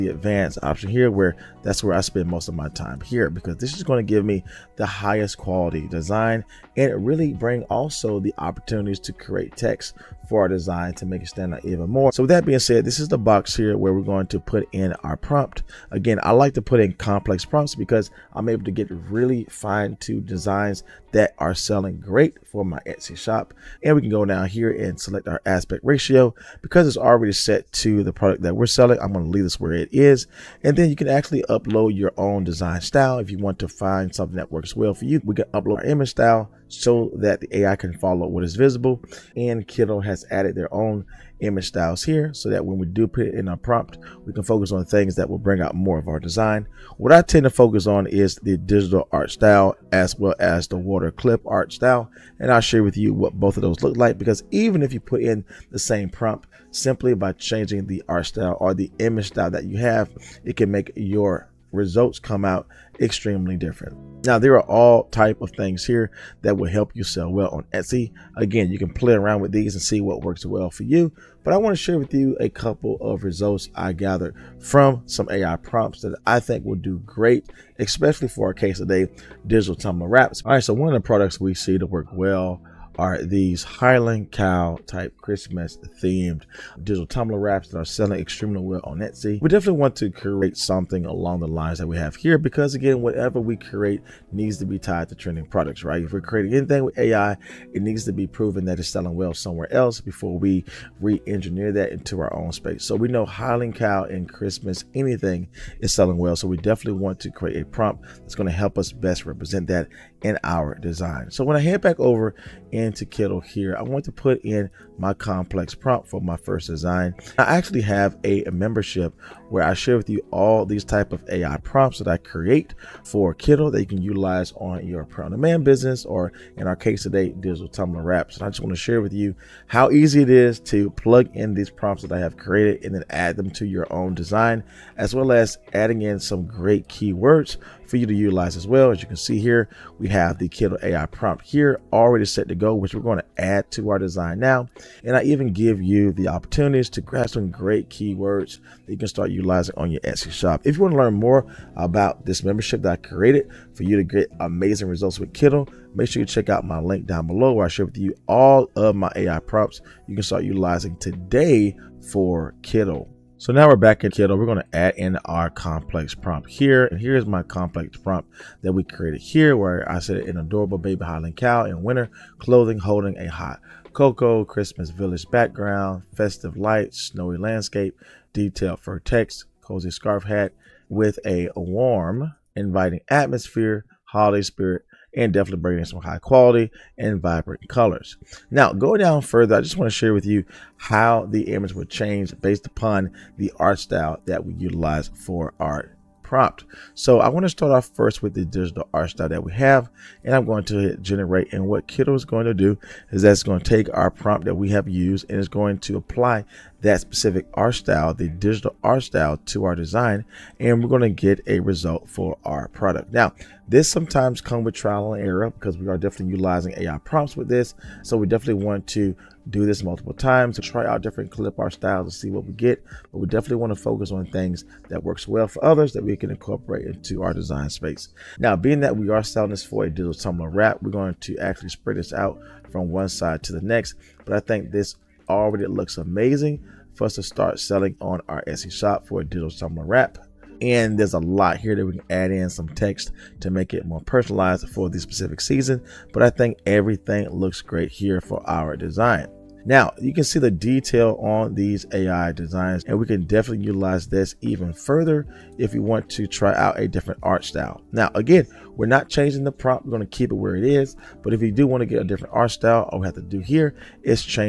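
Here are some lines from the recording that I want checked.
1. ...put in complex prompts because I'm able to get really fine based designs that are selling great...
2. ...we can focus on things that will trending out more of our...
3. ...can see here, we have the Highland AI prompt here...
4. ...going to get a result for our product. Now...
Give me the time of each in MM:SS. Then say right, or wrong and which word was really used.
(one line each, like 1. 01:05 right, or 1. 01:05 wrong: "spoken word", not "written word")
1. 00:16 wrong: "tuned", not "based"
2. 00:44 wrong: "bring", not "trending"
3. 02:19 wrong: "Kittl", not "Highland"
4. 03:30 right.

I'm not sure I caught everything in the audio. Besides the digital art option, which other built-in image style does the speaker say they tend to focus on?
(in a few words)
water clip art style.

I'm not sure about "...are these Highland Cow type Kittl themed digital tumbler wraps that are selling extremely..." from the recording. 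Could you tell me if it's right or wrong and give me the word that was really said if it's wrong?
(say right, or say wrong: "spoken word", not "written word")
wrong: "Christmas", not "Kittl".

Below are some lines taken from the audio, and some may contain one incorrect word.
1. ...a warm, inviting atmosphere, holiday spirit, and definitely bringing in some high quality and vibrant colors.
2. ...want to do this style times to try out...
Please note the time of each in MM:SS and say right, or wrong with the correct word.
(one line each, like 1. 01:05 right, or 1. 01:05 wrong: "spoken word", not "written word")
1. 03:01 right
2. 03:38 wrong: "multiple", not "style".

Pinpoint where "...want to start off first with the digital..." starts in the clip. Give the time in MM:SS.
03:17.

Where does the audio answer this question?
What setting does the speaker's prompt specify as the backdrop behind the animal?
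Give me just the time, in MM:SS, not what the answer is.
02:54.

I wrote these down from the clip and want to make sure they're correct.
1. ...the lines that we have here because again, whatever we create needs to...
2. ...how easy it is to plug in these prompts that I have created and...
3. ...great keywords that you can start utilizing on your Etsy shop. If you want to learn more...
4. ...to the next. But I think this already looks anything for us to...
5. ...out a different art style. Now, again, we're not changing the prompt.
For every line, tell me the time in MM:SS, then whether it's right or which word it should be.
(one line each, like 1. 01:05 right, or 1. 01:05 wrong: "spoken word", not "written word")
1. 01:31 right
2. 02:09 right
3. 02:27 right
4. 03:53 wrong: "amazing", not "anything"
5. 04:16 right.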